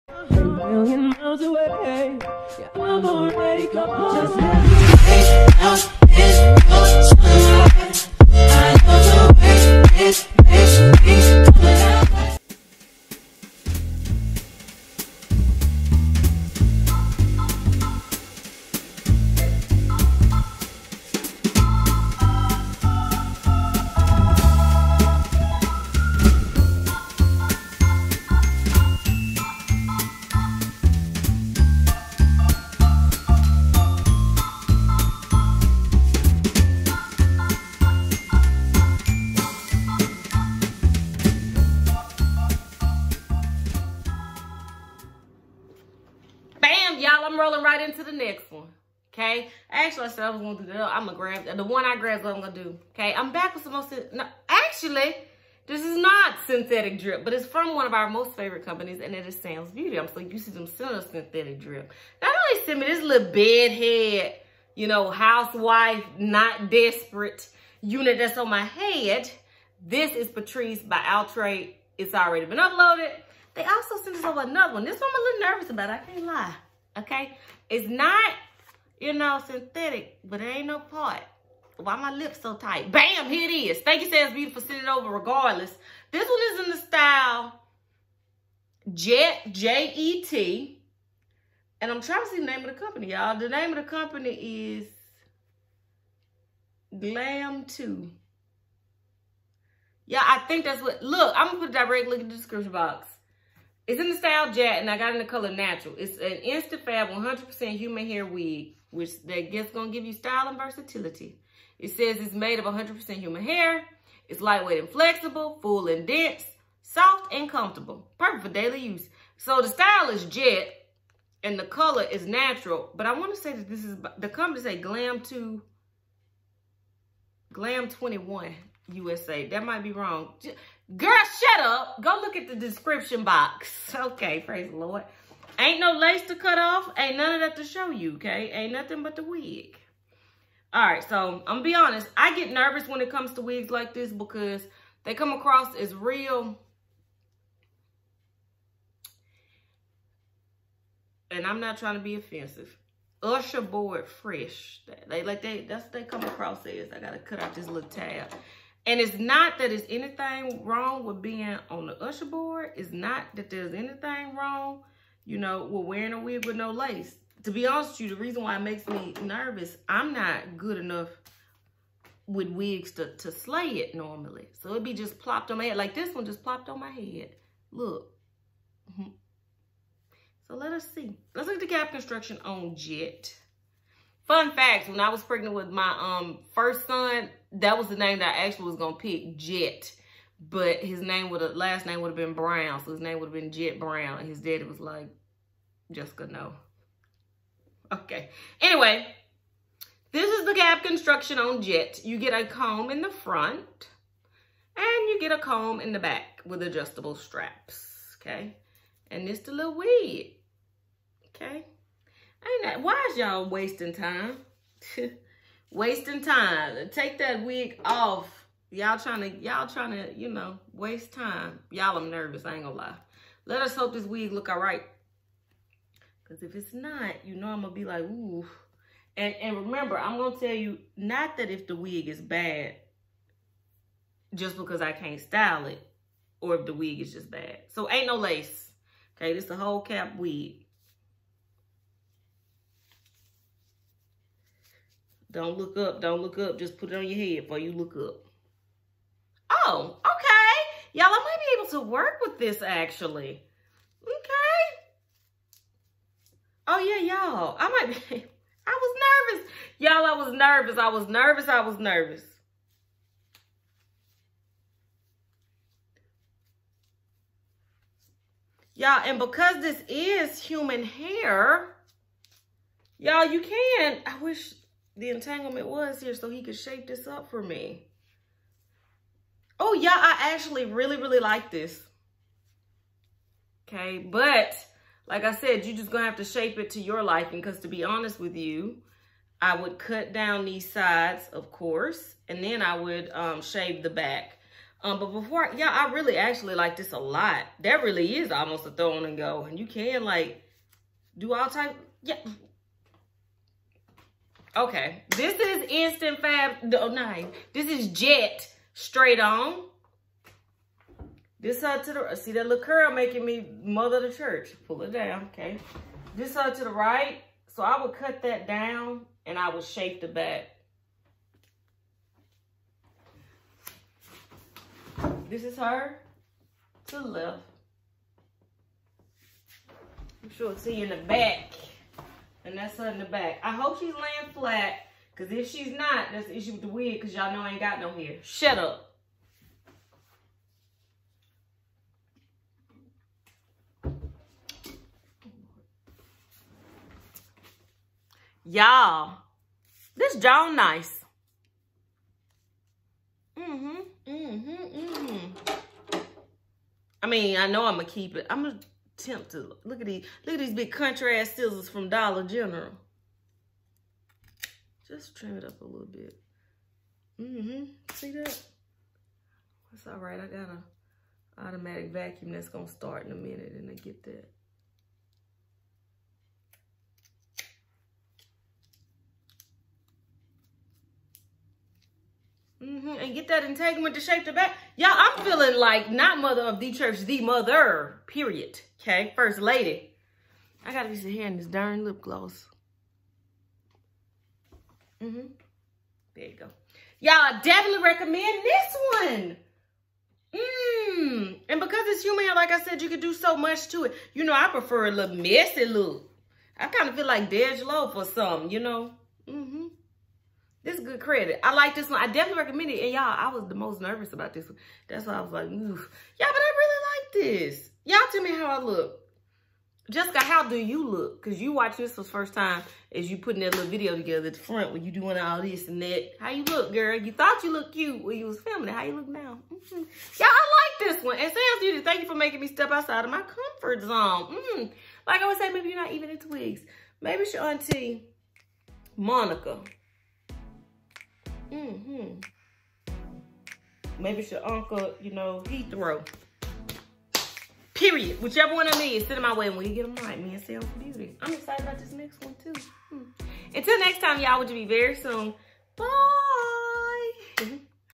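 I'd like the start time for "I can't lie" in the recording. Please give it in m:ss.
1:15.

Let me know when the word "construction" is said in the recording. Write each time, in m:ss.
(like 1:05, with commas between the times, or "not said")
3:01, 3:20.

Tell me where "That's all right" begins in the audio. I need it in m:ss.
6:09.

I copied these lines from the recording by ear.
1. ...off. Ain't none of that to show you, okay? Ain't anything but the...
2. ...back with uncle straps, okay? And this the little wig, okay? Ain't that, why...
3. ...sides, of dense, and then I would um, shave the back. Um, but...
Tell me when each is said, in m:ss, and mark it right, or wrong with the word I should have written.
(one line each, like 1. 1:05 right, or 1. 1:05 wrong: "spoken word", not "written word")
1. 2:16 wrong: "nothing", not "anything"
2. 3:25 wrong: "adjustable", not "uncle"
3. 4:50 wrong: "course", not "dense".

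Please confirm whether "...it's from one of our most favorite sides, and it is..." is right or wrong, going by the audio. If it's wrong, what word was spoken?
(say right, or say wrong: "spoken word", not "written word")
wrong: "companies", not "sides".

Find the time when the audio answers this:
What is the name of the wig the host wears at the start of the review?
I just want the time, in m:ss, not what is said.
1:10.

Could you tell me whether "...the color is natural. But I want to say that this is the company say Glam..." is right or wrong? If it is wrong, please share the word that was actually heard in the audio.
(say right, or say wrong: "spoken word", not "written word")
right.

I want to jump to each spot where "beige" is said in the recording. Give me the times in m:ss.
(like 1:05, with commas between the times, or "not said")
6:47.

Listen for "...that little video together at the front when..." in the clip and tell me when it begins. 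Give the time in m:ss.
7:03.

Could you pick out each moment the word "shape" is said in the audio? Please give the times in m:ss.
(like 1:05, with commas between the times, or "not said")
4:36, 4:46, 5:19, 6:24.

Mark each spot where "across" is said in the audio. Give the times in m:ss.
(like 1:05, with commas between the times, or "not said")
2:25, 2:36.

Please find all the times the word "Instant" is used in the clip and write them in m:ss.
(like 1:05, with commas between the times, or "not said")
1:46, 5:05.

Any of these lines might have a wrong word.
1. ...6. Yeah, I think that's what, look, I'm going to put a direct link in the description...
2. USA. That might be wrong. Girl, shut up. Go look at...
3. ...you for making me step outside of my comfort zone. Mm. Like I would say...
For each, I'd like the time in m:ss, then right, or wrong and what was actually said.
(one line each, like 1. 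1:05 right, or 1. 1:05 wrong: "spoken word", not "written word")
1. 1:37 wrong: "2", not "6"
2. 2:08 right
3. 7:12 right.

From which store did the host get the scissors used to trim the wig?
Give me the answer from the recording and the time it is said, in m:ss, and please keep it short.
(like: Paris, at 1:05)
Dollar General, at 6:01.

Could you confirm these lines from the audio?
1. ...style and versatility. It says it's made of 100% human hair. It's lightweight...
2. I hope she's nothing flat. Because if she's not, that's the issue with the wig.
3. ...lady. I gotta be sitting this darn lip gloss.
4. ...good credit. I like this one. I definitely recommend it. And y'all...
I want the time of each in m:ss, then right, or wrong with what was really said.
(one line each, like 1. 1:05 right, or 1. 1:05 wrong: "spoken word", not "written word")
1. 1:50 right
2. 5:33 wrong: "laying", not "nothing"
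3. 6:29 right
4. 6:50 right.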